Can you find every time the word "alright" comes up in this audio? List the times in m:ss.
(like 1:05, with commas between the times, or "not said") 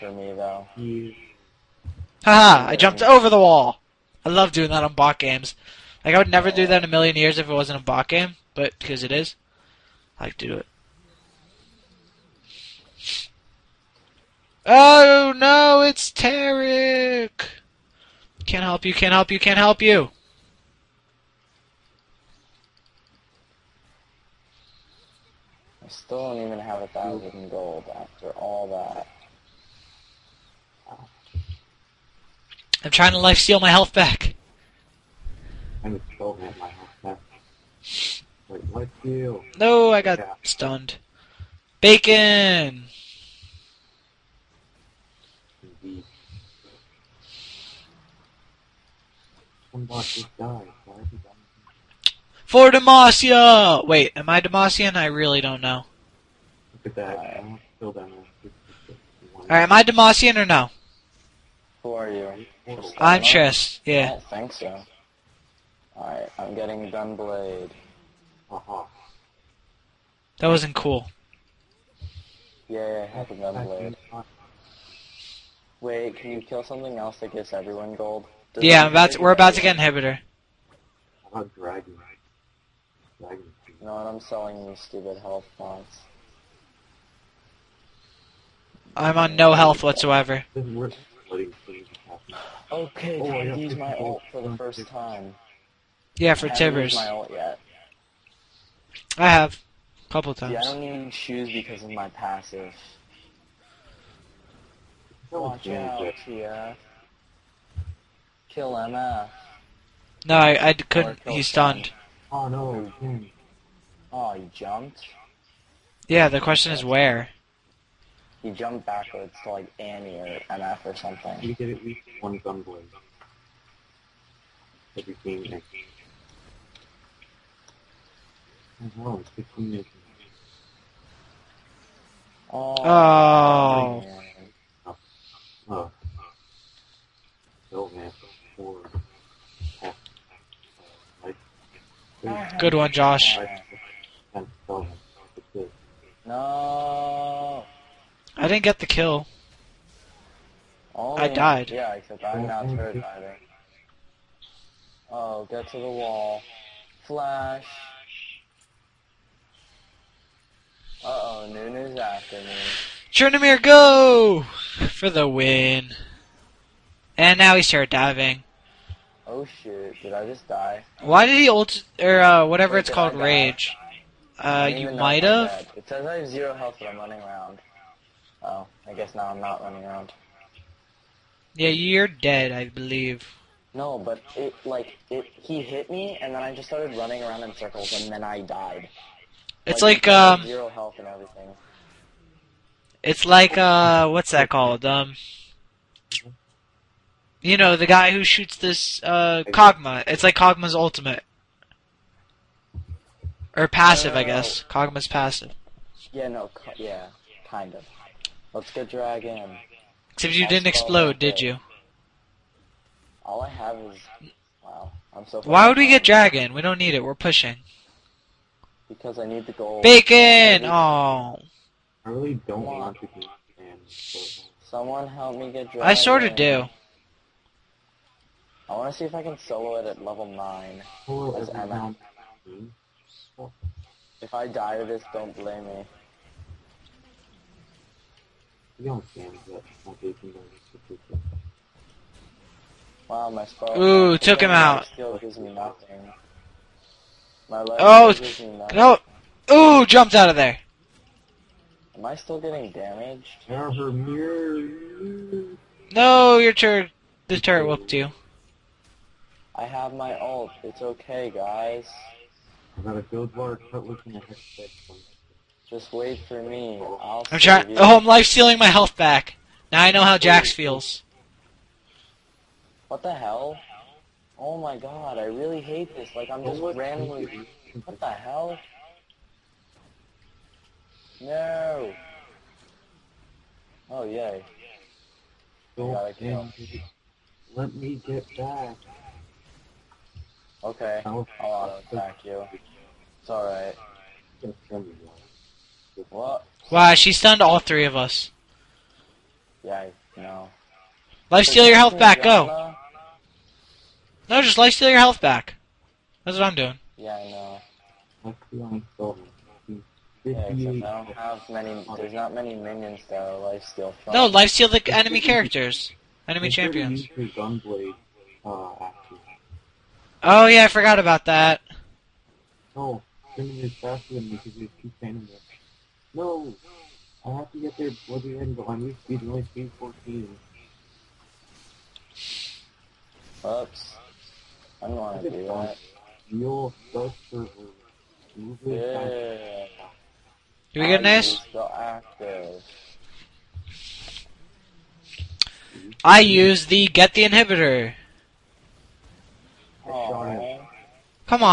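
0:59, 1:05, 4:53.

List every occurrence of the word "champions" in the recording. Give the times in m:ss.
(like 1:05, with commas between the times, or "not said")
5:16.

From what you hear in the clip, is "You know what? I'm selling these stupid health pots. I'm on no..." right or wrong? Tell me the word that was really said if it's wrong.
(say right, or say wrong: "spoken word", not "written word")
right.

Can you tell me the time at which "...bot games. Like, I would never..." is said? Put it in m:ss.
0:04.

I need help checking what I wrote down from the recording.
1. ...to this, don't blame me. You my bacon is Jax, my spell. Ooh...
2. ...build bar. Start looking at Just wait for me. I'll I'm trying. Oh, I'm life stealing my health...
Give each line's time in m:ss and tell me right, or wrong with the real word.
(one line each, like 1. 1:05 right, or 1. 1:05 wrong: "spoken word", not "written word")
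1. 3:54 wrong: "Wow", not "Jax"
2. 4:23 right.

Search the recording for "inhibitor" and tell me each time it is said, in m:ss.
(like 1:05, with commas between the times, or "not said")
1:19, 5:47.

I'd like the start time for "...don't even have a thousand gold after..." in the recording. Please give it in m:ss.
0:26.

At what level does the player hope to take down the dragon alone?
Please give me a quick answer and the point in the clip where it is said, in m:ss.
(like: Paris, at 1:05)
9, at 3:50.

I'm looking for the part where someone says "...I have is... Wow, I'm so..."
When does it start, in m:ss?
3:33.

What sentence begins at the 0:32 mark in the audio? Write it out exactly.
I'm trying to life steal my health back.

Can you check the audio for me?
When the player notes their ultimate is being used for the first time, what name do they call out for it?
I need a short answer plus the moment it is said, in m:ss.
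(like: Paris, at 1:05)
Tibbers, at 1:36.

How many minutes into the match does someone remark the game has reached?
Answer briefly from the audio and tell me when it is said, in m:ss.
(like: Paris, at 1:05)
15, at 2:09.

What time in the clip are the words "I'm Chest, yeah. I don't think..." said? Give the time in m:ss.
1:02.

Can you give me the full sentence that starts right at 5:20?
Oh yeah, I forgot about that.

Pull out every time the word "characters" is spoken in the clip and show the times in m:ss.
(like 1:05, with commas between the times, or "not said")
5:15.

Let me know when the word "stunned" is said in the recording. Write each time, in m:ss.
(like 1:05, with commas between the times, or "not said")
0:40, 1:51, 4:57.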